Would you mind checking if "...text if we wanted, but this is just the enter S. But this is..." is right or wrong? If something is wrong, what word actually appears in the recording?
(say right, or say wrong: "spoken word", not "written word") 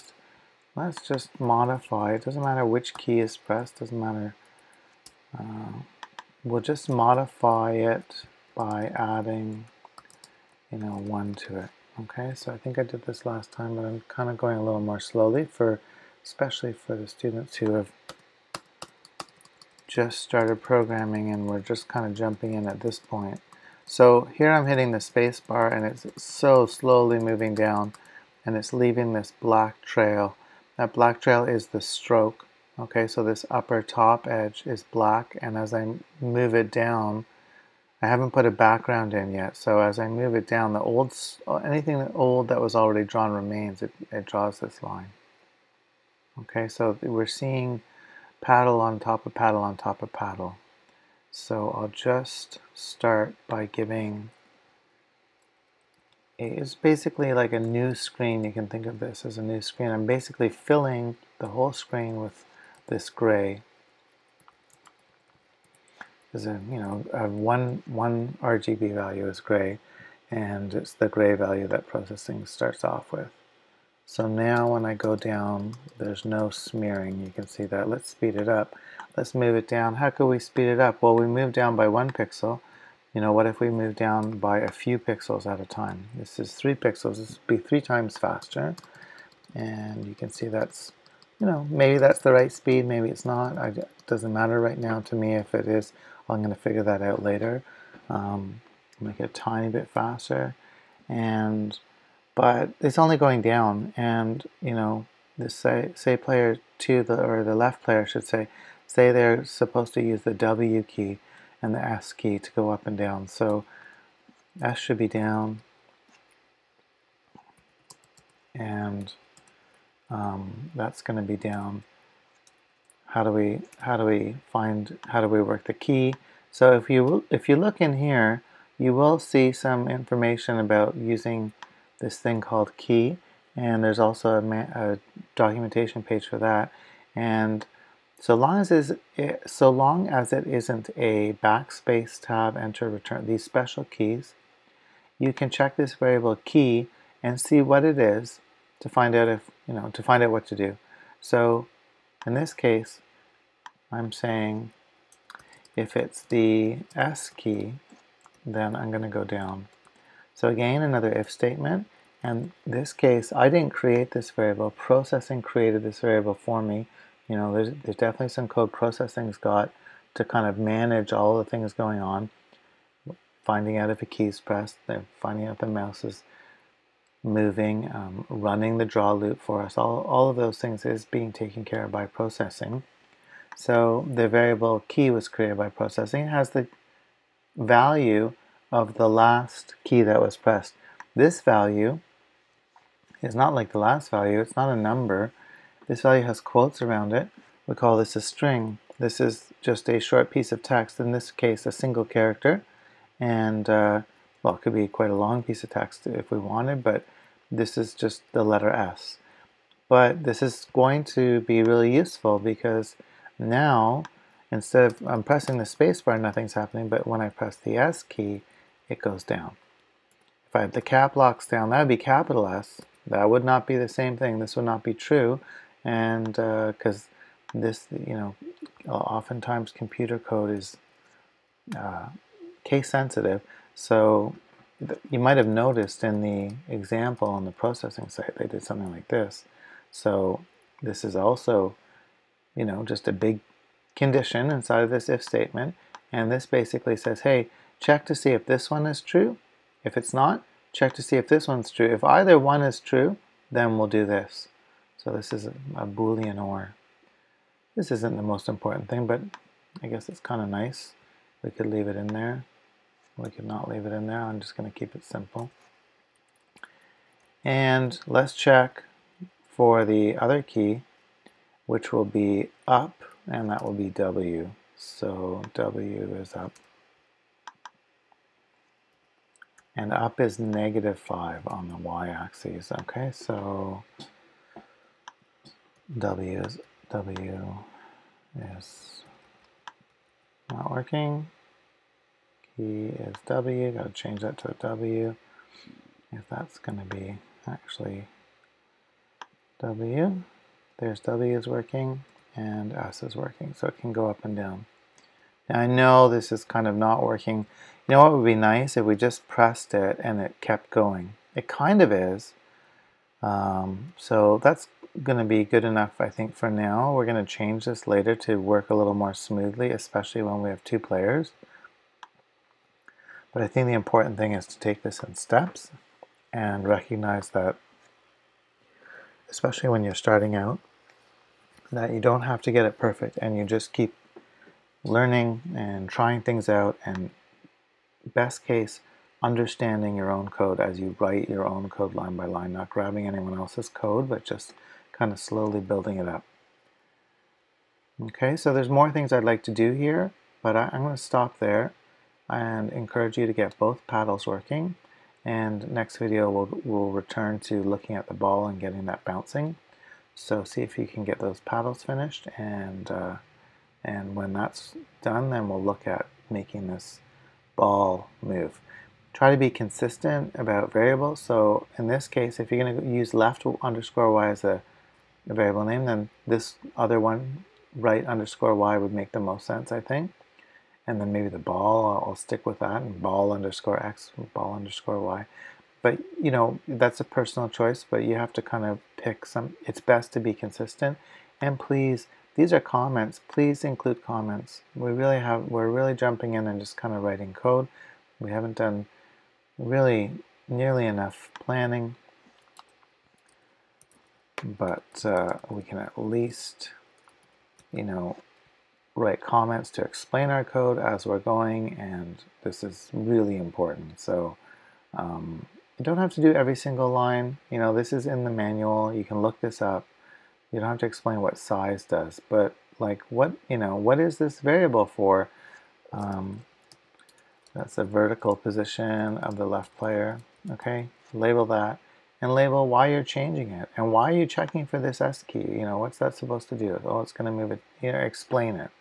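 wrong: "letter", not "enter".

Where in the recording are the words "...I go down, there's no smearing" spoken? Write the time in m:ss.
1:14.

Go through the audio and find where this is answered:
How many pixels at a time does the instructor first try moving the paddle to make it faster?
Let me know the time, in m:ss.
1:26.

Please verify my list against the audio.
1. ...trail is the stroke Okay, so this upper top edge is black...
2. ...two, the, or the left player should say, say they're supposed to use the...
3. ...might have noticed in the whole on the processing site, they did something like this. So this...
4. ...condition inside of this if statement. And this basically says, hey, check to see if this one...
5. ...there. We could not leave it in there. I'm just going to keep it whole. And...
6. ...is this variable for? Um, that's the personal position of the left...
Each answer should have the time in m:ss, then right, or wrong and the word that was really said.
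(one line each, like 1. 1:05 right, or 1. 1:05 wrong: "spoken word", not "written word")
1. 0:31 right
2. 1:46 right
3. 3:55 wrong: "example", not "whole"
4. 4:03 right
5. 4:22 wrong: "simple", not "whole"
6. 7:03 wrong: "vertical", not "personal".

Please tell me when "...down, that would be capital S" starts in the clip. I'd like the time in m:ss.
3:41.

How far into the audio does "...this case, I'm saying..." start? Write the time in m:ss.
2:32.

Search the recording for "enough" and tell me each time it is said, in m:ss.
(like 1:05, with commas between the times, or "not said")
5:15, 6:40.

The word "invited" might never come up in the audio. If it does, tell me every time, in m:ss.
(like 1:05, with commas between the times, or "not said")
not said.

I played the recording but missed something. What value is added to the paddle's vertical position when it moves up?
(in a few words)
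-5.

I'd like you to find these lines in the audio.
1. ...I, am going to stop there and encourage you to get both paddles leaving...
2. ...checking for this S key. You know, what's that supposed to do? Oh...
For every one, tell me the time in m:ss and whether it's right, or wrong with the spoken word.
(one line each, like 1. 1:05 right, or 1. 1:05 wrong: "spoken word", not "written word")
1. 5:50 wrong: "working", not "leaving"
2. 7:14 right.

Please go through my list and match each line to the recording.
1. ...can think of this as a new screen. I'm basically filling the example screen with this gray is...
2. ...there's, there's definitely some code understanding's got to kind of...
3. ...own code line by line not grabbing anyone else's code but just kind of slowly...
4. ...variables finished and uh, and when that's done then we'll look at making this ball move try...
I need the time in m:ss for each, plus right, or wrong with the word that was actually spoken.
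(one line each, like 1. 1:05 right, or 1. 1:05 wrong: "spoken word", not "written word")
1. 0:58 wrong: "whole", not "example"
2. 2:47 wrong: "processing", not "understanding"
3. 5:41 right
4. 6:01 wrong: "paddles", not "variables".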